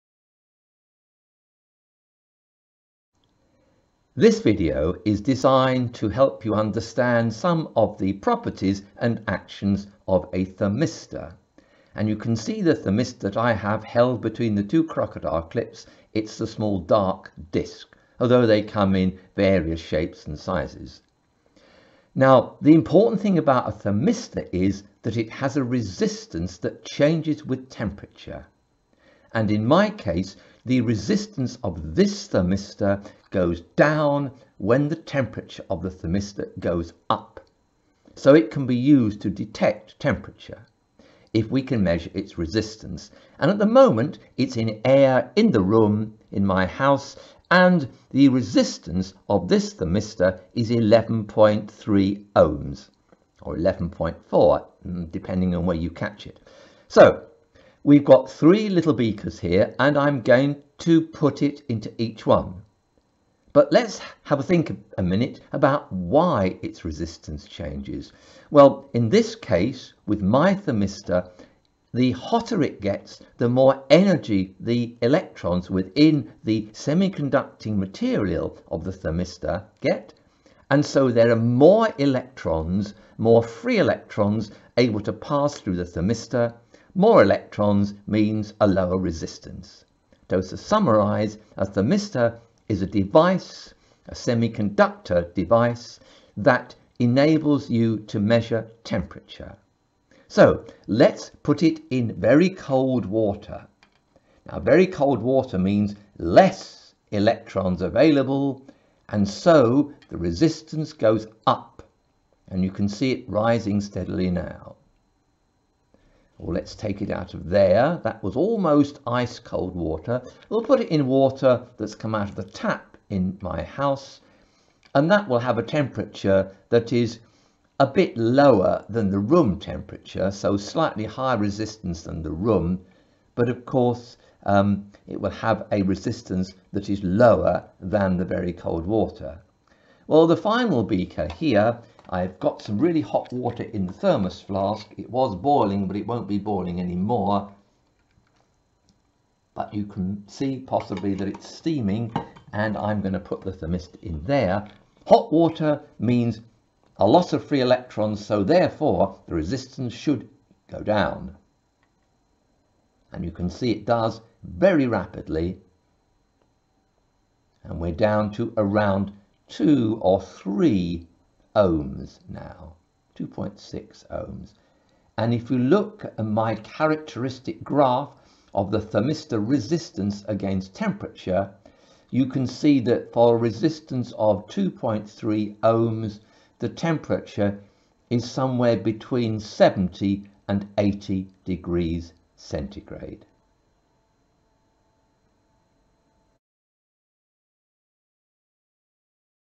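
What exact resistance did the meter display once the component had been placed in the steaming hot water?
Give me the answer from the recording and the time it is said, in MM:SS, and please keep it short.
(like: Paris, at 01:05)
2.6 ohms, at 02:53.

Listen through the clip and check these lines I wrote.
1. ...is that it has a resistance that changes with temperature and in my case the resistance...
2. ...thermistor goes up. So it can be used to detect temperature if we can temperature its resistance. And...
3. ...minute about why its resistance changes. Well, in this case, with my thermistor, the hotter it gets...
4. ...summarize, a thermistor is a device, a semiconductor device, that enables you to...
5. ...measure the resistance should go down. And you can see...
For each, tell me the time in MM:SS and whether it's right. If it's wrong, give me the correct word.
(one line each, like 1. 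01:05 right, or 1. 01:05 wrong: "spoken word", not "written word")
1. 00:24 right
2. 00:35 wrong: "measure", not "temperature"
3. 01:05 right
4. 01:30 right
5. 02:38 wrong: "therefore", not "measure".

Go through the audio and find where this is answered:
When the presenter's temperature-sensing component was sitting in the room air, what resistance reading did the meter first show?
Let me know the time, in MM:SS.
00:50.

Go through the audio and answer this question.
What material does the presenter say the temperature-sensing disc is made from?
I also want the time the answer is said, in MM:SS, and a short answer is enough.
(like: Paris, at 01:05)
semiconducting material, at 01:16.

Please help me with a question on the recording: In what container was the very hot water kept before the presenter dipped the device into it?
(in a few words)
thermos flask.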